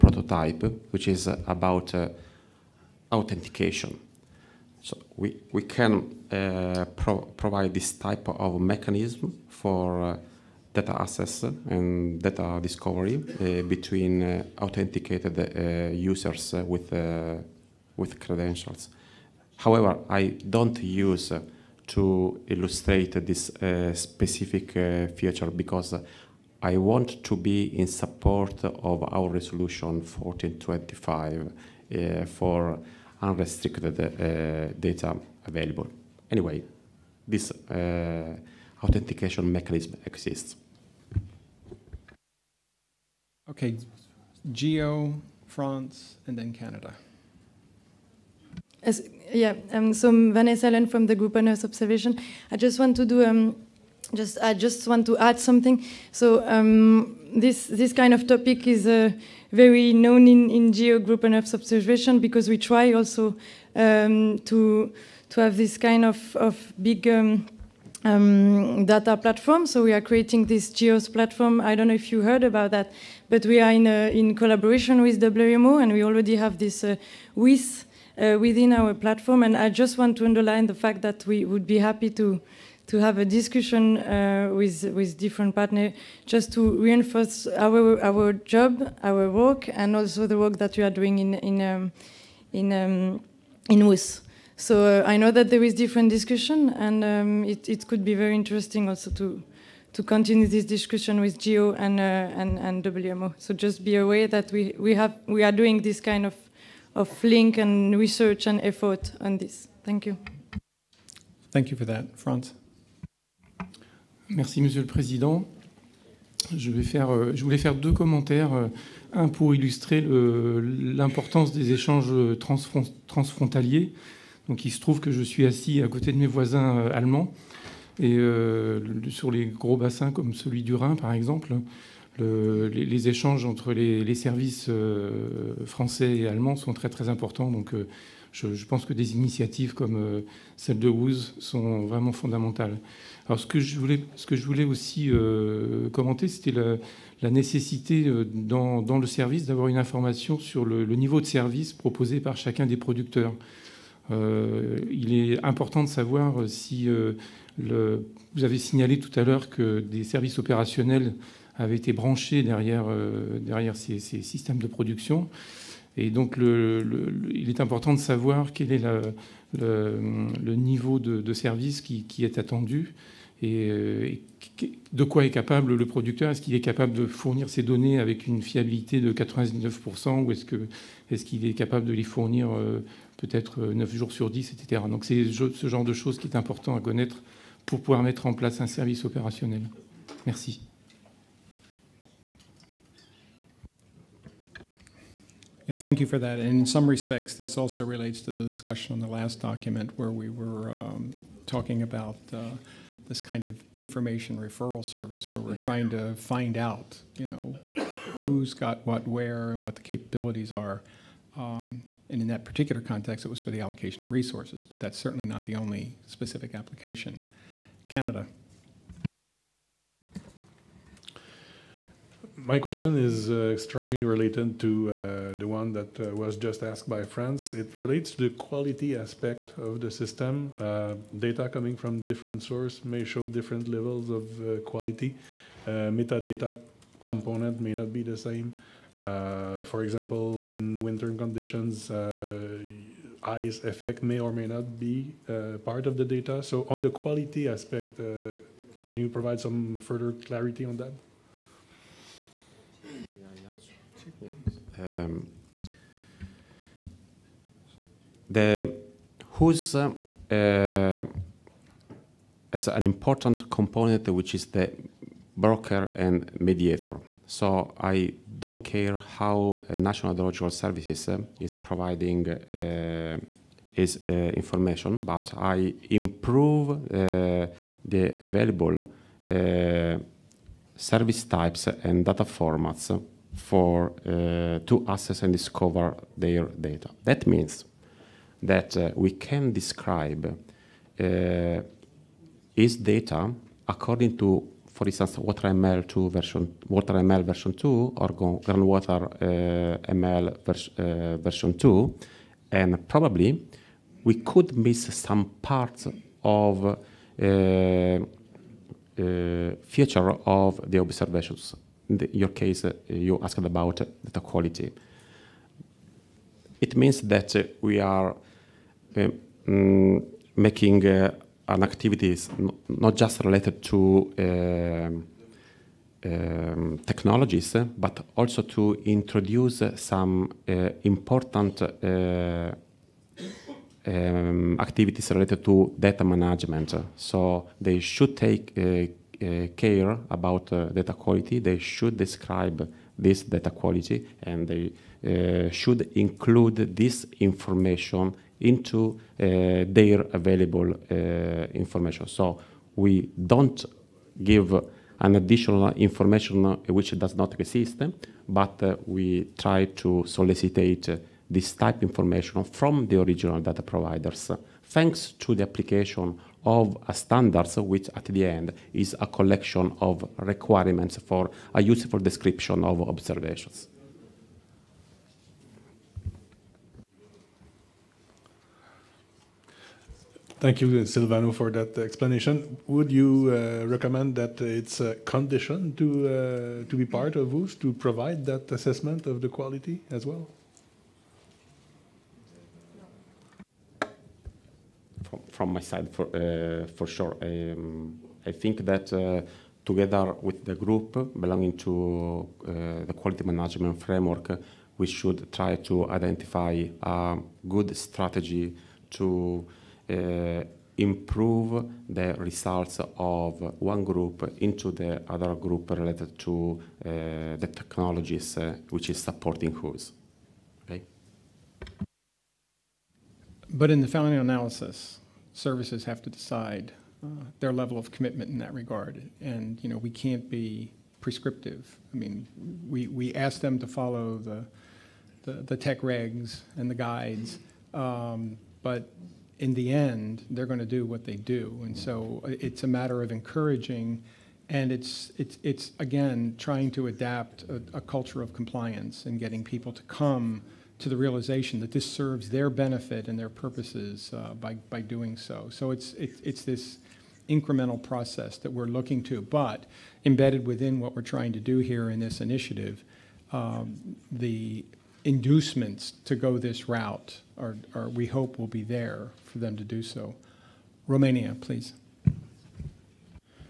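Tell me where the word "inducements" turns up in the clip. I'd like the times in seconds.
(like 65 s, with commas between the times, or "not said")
465 s.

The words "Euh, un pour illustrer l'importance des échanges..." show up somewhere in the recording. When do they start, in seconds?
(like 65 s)
118 s.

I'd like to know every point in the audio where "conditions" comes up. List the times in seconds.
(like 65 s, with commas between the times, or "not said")
241 s, 384 s.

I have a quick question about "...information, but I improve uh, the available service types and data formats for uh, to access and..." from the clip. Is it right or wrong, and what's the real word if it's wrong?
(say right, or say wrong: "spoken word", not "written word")
right.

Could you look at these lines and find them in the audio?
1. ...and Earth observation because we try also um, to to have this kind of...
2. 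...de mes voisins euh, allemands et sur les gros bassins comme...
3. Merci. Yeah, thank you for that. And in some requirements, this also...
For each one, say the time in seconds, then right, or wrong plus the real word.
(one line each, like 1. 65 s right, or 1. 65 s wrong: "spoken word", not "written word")
1. 61 s right
2. 126 s right
3. 190 s wrong: "respects", not "requirements".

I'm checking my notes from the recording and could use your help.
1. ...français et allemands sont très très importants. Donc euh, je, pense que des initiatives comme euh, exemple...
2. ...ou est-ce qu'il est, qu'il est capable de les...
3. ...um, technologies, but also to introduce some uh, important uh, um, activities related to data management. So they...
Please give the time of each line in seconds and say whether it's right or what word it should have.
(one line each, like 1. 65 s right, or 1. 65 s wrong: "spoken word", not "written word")
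1. 135 s wrong: "celle", not "exemple"
2. 180 s right
3. 326 s right.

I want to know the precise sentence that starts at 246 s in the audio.
So on the quality aspect, can you provide some further clarity on that?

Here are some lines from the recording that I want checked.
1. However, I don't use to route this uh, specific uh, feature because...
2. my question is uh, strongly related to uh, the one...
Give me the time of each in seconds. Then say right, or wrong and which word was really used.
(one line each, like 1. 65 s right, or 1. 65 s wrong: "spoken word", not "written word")
1. 19 s wrong: "illustrate", not "route"
2. 222 s right.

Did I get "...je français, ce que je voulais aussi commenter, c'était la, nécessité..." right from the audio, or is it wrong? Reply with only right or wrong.
wrong.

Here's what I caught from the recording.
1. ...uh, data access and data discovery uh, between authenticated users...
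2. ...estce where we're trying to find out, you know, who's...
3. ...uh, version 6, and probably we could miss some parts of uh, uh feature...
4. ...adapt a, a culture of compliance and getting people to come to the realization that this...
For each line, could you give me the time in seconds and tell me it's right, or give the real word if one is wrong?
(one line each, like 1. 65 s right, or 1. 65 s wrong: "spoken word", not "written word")
1. 10 s right
2. 204 s wrong: "service", not "estce"
3. 300 s wrong: "2", not "6"
4. 446 s right.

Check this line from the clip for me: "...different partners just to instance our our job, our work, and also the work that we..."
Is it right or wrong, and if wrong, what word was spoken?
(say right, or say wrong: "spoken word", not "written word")
wrong: "reinforce", not "instance".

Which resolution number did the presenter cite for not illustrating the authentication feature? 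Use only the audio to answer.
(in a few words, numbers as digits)
1425.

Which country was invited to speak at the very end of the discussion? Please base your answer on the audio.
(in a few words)
Romania.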